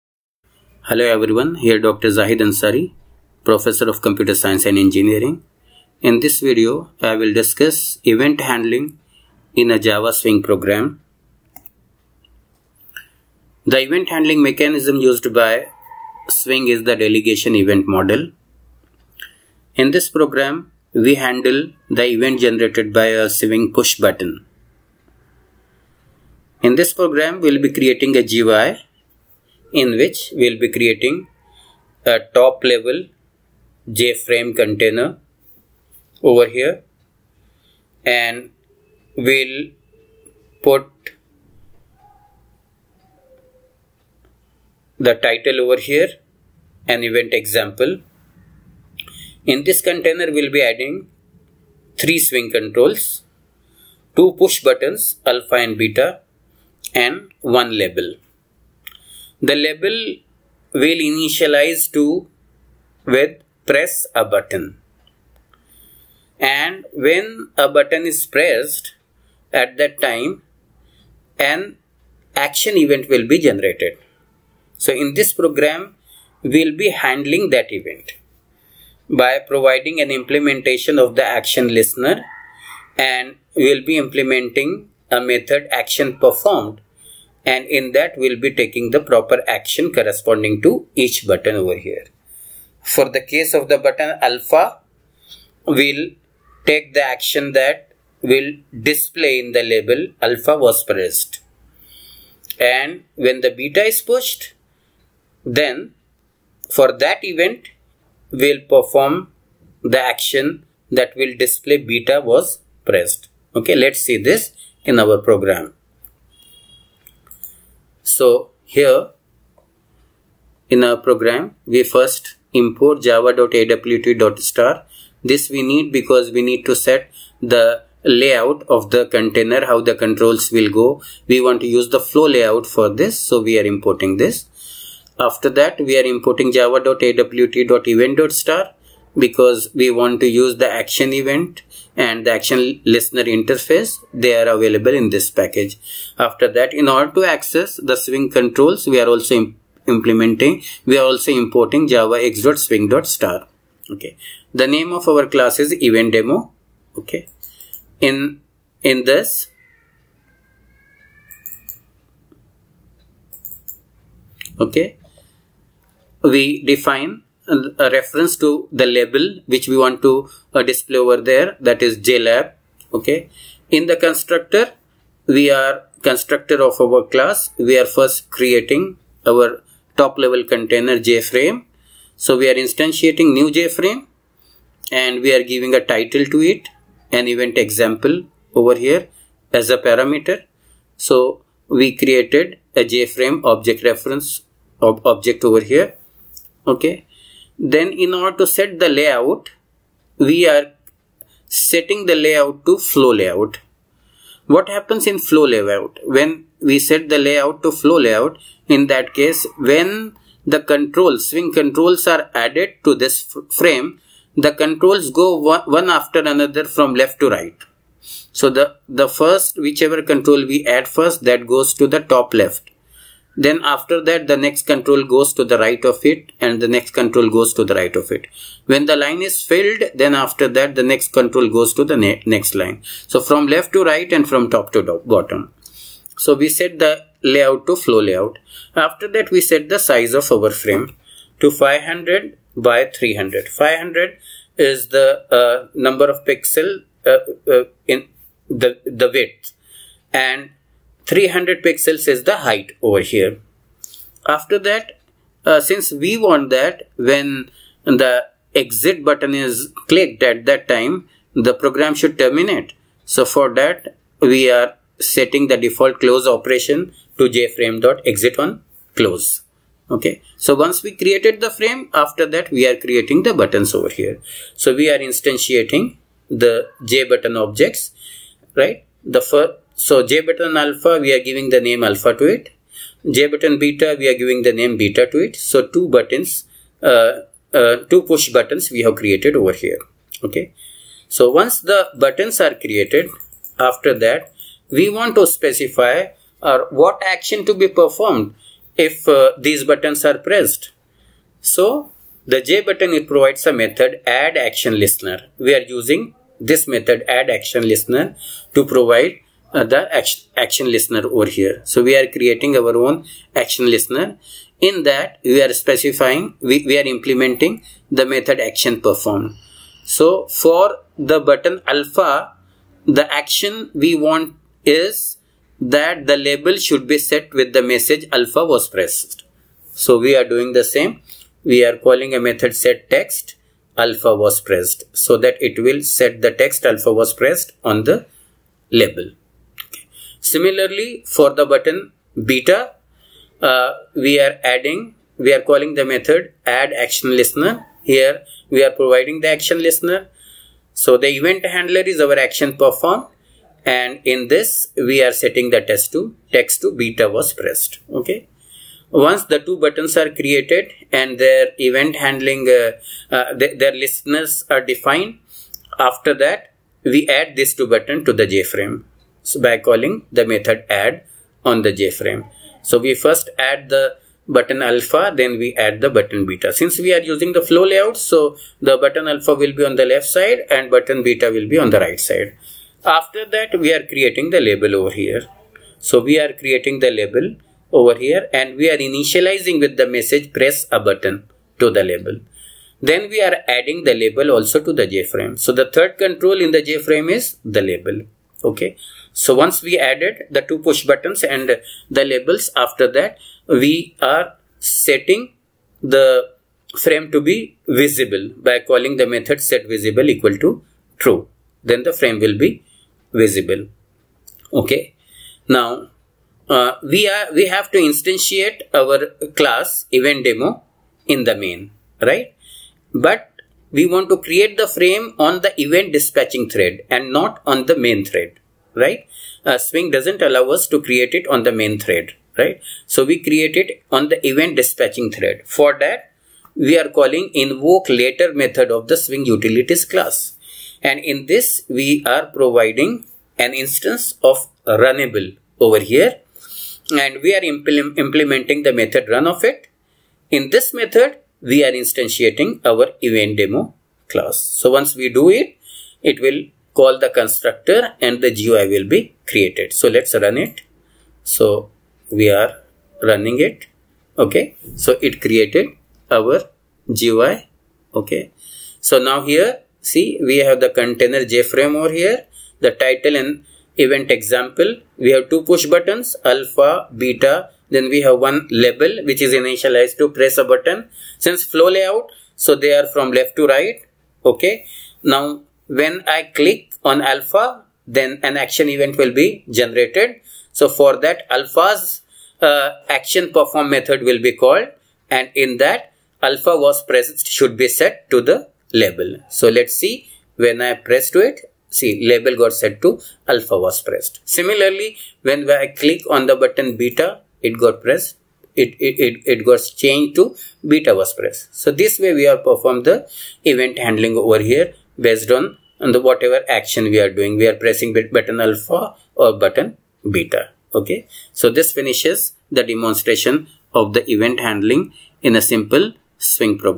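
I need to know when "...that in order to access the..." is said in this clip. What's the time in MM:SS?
02:26.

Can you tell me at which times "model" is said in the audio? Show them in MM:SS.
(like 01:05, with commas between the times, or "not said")
00:17.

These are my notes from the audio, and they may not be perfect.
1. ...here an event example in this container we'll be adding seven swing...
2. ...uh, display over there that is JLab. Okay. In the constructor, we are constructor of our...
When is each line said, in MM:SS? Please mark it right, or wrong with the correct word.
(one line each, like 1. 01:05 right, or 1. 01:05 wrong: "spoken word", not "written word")
1. 00:45 wrong: "three", not "seven"
2. 02:50 right.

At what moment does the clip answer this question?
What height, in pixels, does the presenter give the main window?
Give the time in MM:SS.
04:11.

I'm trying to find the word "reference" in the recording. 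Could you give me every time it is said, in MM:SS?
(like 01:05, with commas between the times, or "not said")
02:47, 03:13.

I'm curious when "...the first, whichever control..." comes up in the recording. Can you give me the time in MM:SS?
03:38.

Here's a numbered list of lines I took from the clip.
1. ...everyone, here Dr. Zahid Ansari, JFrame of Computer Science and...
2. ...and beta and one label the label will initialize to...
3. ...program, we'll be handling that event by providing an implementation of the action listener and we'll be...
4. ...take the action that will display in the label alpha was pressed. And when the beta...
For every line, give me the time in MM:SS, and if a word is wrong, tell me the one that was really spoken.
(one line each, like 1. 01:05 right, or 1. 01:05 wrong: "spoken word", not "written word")
1. 00:01 wrong: "Professor", not "JFrame"
2. 00:55 right
3. 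01:15 right
4. 01:36 right.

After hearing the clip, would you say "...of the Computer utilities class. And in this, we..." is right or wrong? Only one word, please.
wrong.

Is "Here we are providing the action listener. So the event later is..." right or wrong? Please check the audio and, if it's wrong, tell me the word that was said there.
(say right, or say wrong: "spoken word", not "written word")
wrong: "handler", not "later".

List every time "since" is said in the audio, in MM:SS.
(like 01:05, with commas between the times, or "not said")
04:15, 06:16, 08:01.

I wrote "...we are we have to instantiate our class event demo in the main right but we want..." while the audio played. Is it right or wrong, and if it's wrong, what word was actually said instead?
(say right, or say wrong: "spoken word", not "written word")
right.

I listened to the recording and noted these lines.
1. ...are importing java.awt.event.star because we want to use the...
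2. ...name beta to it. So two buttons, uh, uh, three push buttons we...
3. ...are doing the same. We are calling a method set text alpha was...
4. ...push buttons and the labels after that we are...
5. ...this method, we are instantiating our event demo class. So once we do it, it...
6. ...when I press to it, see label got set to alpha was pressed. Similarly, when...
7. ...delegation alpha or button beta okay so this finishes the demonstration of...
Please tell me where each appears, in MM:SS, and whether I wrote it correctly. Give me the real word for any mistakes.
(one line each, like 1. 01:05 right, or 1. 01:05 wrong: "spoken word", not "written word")
1. 02:15 right
2. 04:44 wrong: "two", not "three"
3. 05:30 right
4. 06:40 right
5. 07:30 right
6. 08:20 right
7. 08:37 wrong: "button", not "delegation".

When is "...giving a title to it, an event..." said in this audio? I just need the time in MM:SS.
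03:05.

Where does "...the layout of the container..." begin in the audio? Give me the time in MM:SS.
02:07.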